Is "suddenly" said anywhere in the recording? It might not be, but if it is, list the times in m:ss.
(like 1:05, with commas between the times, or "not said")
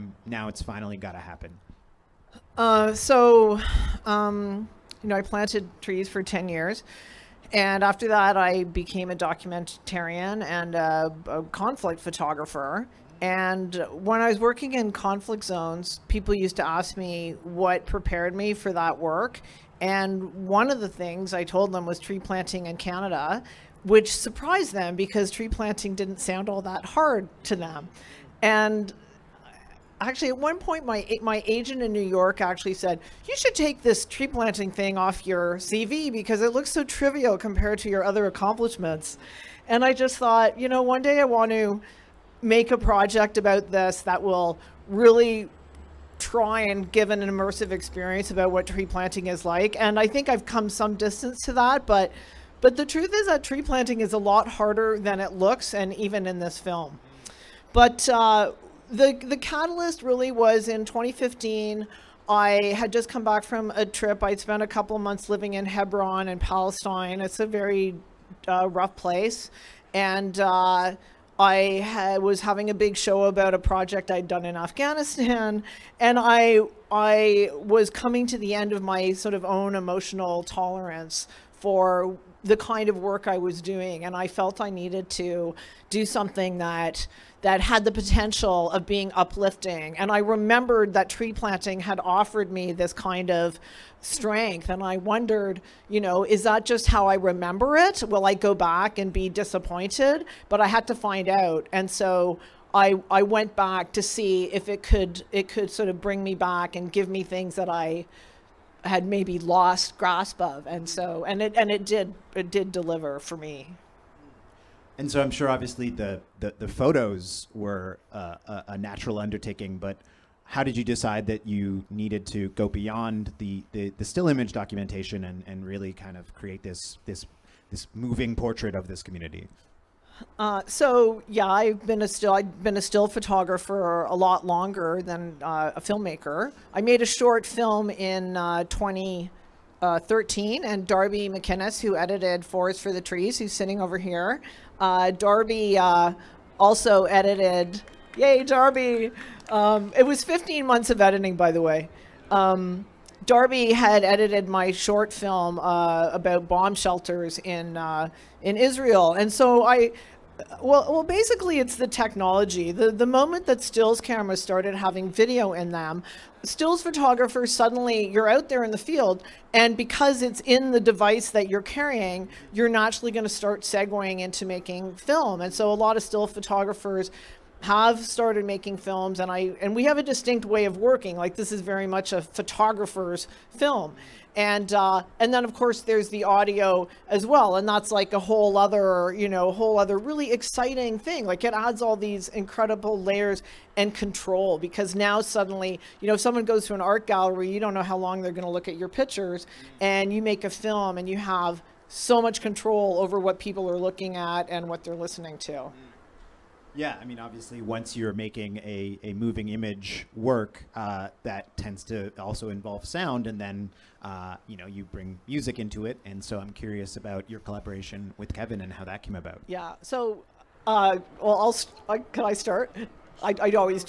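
2:47, 3:15.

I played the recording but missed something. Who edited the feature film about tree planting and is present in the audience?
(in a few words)
Darby McInnes.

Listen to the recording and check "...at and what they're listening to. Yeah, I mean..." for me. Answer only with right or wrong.
right.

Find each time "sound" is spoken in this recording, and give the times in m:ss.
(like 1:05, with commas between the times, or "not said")
0:26, 3:32.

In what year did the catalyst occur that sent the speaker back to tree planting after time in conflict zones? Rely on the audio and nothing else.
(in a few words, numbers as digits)
2015.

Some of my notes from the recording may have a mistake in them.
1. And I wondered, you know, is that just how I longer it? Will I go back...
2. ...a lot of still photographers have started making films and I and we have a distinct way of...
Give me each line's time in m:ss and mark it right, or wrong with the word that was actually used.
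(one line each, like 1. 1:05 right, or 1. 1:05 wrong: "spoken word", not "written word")
1. 1:34 wrong: "remember", not "longer"
2. 2:55 right.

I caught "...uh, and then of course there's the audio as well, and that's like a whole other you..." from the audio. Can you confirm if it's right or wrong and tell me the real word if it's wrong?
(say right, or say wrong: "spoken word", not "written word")
right.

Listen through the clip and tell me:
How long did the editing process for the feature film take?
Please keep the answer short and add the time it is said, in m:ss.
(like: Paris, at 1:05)
15 months, at 2:30.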